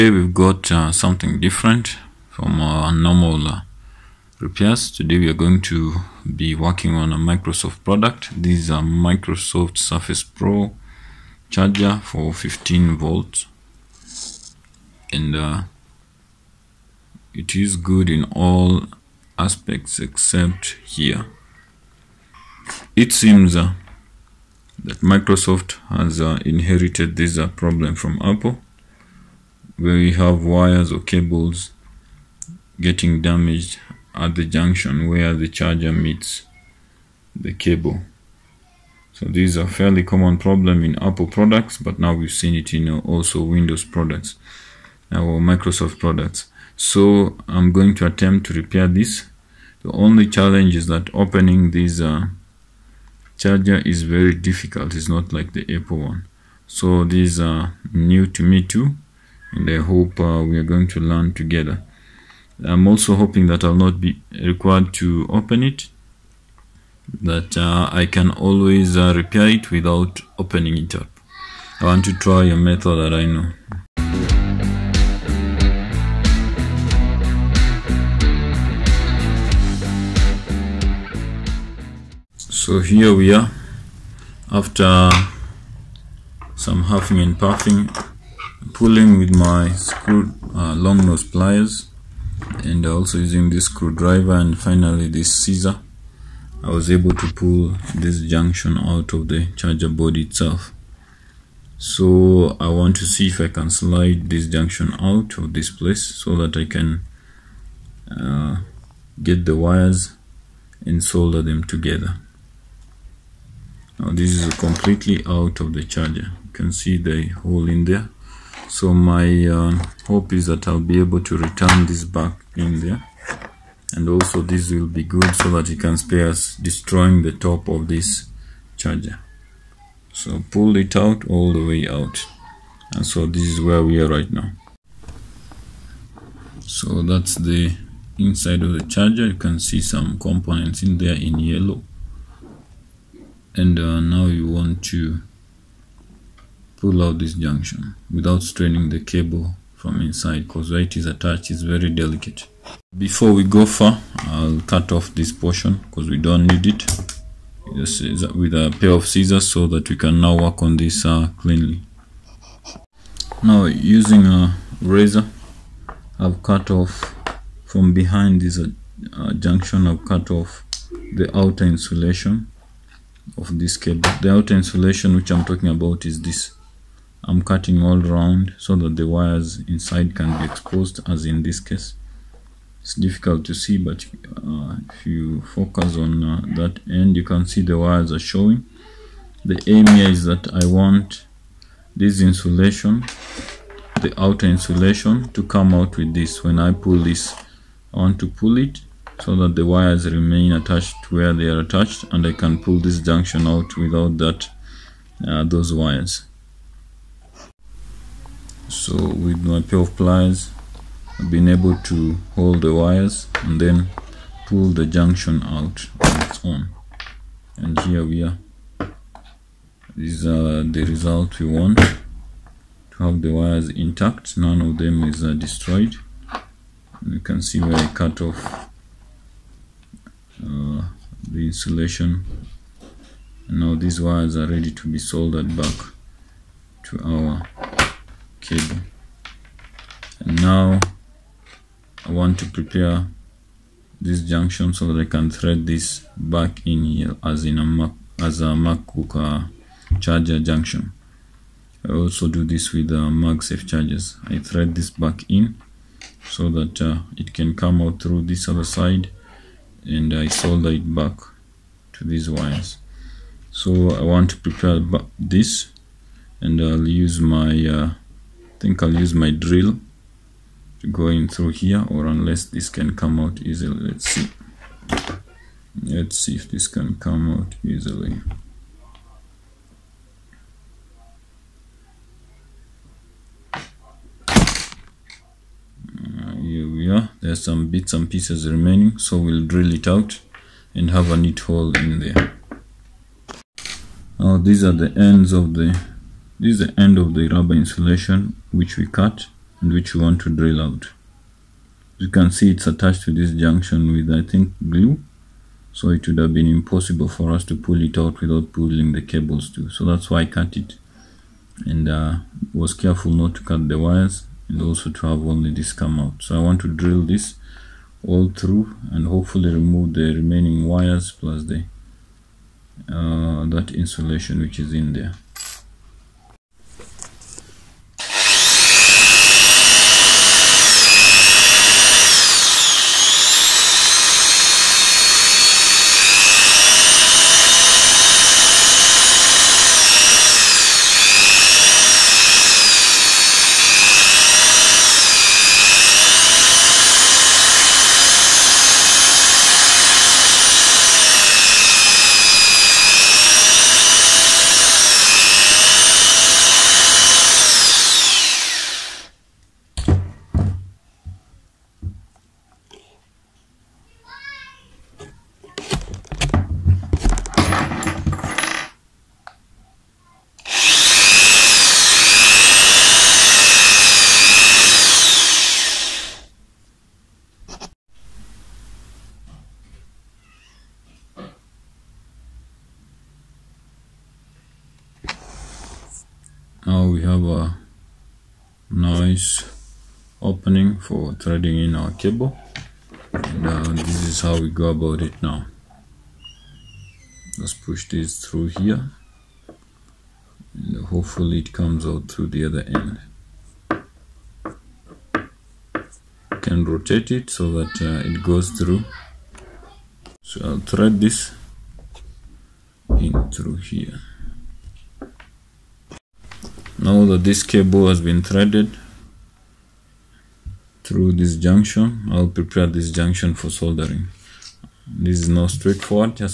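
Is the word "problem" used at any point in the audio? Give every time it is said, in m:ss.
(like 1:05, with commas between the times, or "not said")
0:27, 0:40.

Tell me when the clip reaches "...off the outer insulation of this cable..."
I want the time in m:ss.
2:50.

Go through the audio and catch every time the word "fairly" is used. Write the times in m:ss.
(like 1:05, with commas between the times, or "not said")
0:39.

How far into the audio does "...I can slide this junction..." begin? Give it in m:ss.
1:43.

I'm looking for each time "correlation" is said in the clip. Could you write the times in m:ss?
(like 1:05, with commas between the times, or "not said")
not said.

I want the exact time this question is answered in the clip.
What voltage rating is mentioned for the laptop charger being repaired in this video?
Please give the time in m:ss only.
0:12.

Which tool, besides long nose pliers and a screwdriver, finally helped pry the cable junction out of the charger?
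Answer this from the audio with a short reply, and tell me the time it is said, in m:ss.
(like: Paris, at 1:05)
scissor, at 1:35.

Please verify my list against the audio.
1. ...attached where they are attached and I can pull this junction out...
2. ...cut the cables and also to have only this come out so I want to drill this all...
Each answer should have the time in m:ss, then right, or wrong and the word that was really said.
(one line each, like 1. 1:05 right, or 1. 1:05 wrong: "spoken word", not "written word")
1. 3:20 right
2. 5:13 wrong: "wires", not "cables".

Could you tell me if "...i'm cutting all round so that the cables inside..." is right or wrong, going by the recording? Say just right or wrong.
wrong.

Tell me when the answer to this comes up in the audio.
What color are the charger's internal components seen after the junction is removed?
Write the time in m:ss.
2:21.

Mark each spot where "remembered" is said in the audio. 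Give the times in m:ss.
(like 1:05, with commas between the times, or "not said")
not said.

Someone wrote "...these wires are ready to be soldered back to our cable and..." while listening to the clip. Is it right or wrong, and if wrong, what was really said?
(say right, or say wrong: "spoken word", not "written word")
right.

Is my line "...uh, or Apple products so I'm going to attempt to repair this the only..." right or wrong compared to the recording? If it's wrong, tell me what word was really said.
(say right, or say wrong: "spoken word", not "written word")
wrong: "Microsoft", not "Apple".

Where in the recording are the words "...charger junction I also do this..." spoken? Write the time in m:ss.
4:10.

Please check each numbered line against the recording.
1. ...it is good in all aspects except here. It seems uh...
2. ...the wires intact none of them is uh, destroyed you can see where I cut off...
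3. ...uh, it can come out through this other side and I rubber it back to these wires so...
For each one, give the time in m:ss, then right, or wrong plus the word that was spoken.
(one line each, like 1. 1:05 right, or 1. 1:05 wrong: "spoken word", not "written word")
1. 0:17 right
2. 3:43 right
3. 4:16 wrong: "solder", not "rubber".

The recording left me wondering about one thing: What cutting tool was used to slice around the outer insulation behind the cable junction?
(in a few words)
razor.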